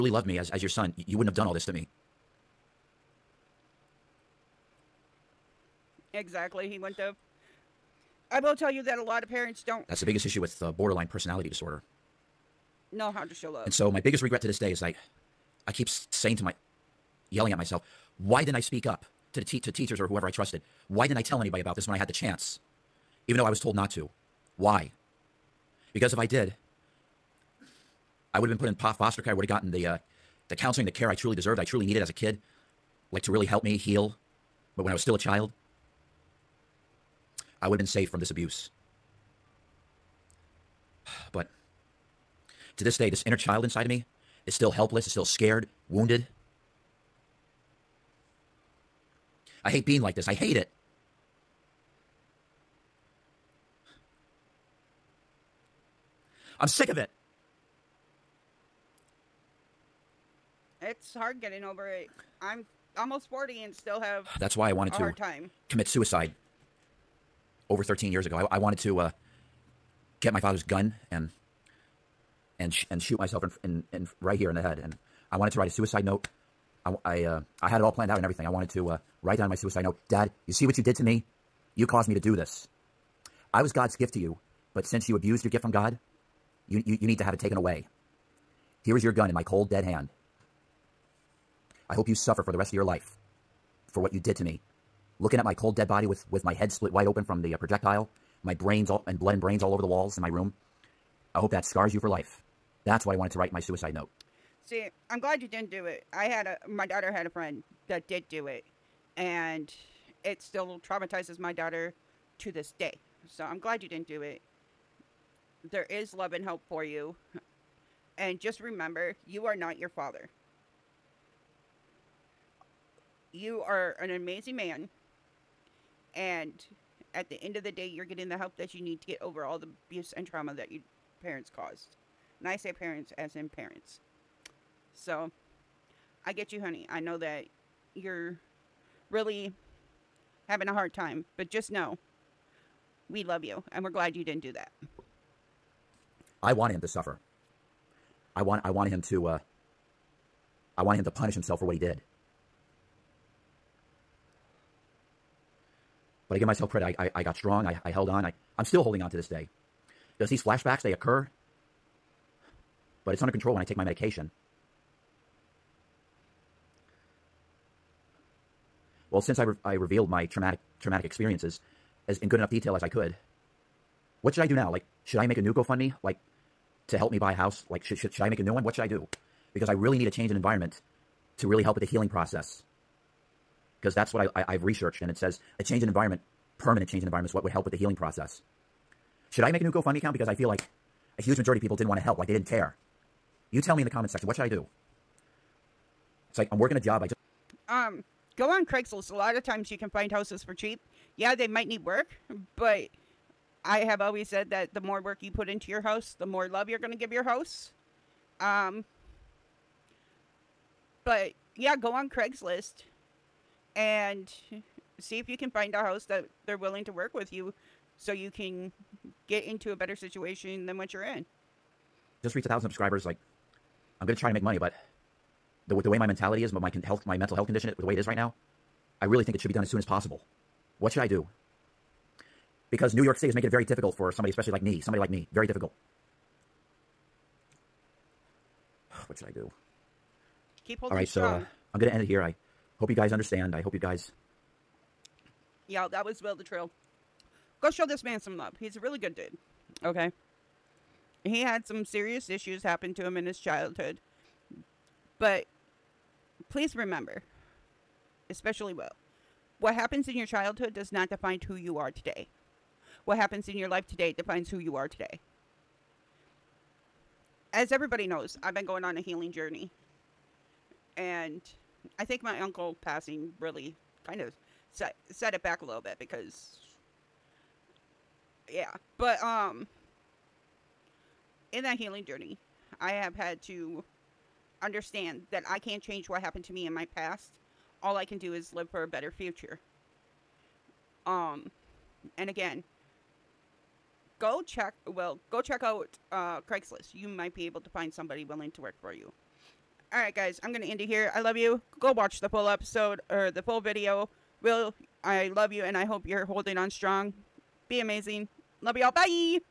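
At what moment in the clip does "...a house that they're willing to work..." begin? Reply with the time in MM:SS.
03:35.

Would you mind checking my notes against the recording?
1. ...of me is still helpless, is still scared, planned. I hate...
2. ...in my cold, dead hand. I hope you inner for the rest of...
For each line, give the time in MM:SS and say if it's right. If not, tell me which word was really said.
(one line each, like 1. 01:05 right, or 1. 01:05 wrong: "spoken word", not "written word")
1. 00:43 wrong: "wounded", not "planned"
2. 01:29 wrong: "suffer", not "inner".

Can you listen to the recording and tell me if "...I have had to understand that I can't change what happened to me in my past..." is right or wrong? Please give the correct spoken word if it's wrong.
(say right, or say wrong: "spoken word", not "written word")
right.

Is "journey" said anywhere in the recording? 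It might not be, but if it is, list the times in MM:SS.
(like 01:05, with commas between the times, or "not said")
04:29, 04:42.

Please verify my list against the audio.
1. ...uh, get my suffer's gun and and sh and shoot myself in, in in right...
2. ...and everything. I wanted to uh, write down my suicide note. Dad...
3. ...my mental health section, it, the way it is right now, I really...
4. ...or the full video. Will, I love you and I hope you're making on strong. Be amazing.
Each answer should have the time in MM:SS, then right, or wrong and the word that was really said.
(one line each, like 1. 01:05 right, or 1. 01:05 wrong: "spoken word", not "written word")
1. 01:08 wrong: "father", not "suffer"
2. 01:18 right
3. 03:47 wrong: "condition", not "section"
4. 05:03 wrong: "holding", not "making".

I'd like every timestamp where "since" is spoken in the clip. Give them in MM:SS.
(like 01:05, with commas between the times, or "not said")
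01:24, 02:49.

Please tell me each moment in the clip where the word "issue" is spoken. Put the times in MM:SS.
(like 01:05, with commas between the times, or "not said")
00:10, 04:12.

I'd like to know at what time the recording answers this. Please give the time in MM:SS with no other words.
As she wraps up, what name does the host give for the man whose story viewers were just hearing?
04:06.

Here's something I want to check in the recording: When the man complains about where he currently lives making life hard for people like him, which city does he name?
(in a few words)
New York City.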